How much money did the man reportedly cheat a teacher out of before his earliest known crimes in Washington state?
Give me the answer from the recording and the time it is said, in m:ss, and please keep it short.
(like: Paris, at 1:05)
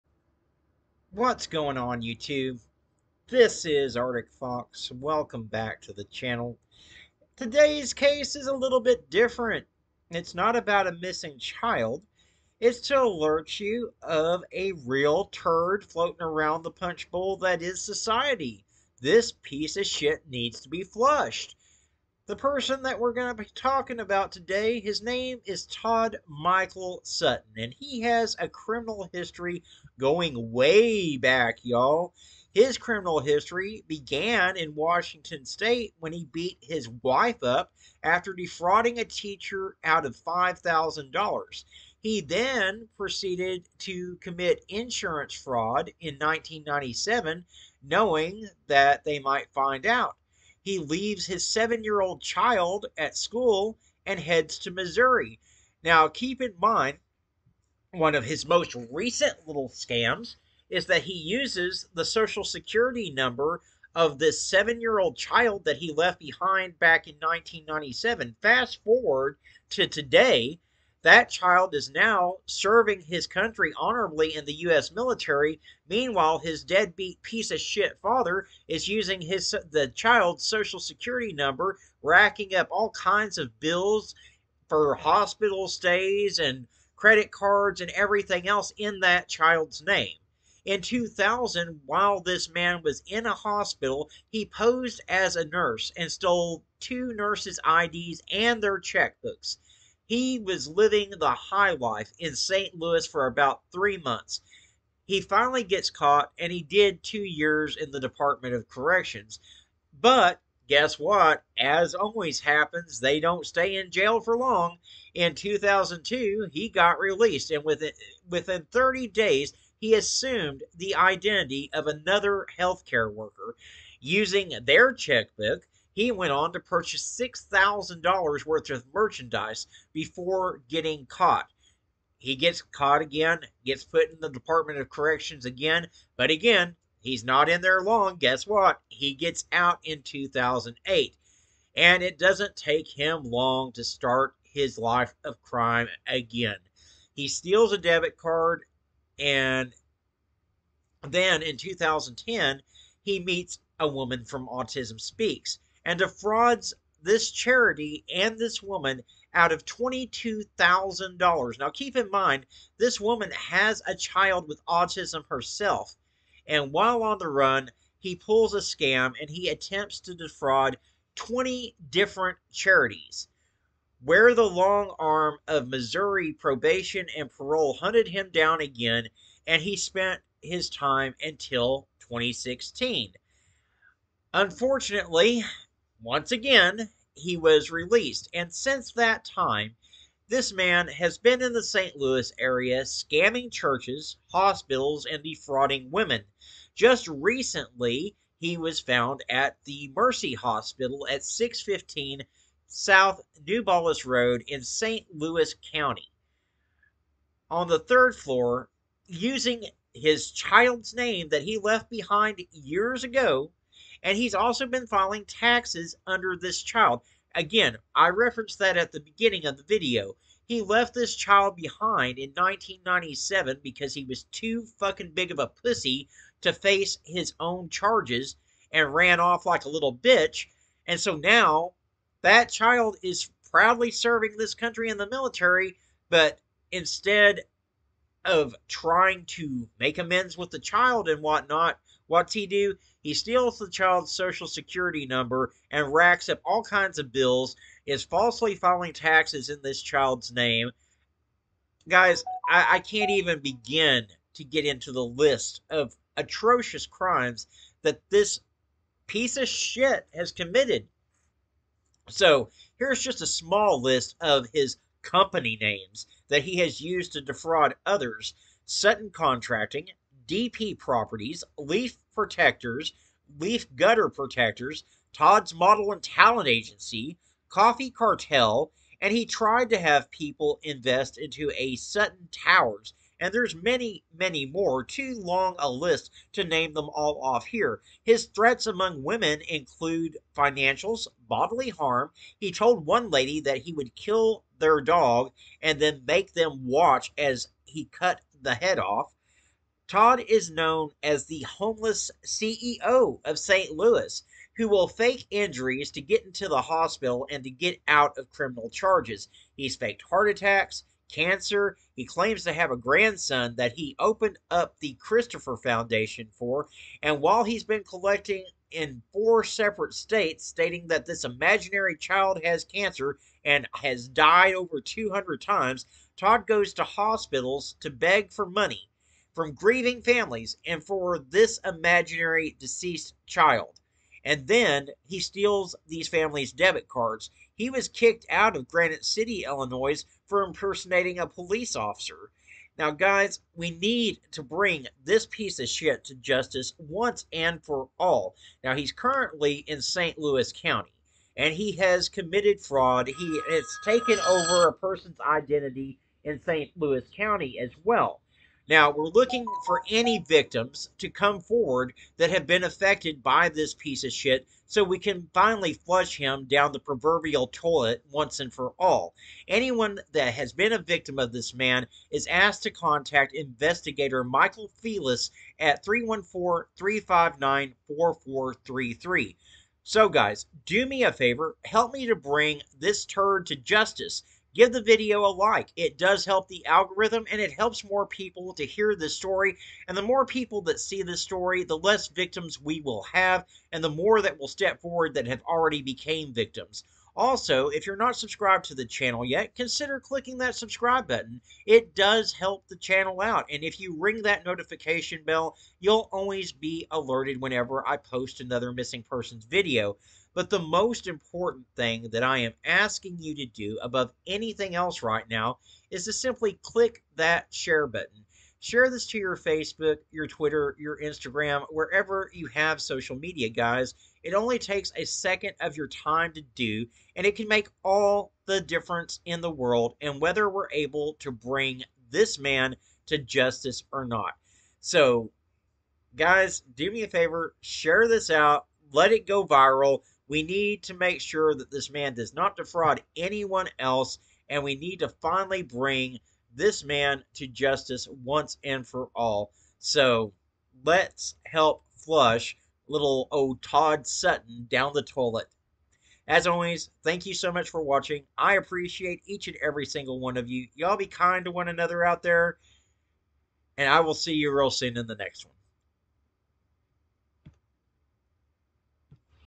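$5,000, at 0:40.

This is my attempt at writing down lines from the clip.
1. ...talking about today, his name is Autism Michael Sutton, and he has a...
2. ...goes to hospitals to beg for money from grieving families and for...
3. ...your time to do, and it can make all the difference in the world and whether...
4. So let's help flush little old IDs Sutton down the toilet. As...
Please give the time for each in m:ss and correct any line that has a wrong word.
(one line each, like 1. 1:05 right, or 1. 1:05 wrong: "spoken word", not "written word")
1. 0:23 wrong: "Todd", not "Autism"
2. 5:26 right
3. 7:05 right
4. 7:29 wrong: "Todd", not "IDs".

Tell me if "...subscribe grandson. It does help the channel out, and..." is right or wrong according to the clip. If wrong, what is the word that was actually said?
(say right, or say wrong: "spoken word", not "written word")
wrong: "button", not "grandson".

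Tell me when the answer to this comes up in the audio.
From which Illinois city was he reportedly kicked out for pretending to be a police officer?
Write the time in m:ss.
5:38.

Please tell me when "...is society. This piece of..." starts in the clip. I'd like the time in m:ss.
0:17.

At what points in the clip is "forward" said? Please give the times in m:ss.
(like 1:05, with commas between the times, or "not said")
1:08, 6:01, 6:34.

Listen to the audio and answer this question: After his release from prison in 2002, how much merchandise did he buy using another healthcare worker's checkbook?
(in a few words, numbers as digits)
$6,000.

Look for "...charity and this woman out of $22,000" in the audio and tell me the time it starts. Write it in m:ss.
2:37.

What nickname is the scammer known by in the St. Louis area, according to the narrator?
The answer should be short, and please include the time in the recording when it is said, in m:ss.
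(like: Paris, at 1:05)
the homeless CEO, at 5:01.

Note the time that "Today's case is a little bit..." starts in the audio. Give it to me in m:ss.
0:07.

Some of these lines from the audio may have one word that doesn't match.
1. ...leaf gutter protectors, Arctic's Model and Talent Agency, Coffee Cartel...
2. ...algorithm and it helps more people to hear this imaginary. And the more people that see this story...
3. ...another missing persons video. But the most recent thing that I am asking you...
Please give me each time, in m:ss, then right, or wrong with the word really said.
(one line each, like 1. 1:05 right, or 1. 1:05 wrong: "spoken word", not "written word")
1. 4:33 wrong: "Todd", not "Arctic"
2. 6:26 wrong: "story", not "imaginary"
3. 6:48 wrong: "important", not "recent".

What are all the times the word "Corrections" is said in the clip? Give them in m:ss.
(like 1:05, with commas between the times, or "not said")
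1:48, 2:14.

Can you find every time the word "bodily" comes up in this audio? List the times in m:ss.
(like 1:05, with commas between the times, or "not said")
4:51.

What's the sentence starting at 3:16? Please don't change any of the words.
Just recently, he was found at the Mercy Hospital at 615 South New Road in St.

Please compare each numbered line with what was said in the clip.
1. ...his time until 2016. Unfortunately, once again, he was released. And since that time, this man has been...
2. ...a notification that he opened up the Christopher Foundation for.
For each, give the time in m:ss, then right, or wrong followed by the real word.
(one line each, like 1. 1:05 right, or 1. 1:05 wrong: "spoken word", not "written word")
1. 3:00 right
2. 5:12 wrong: "grandson", not "notification".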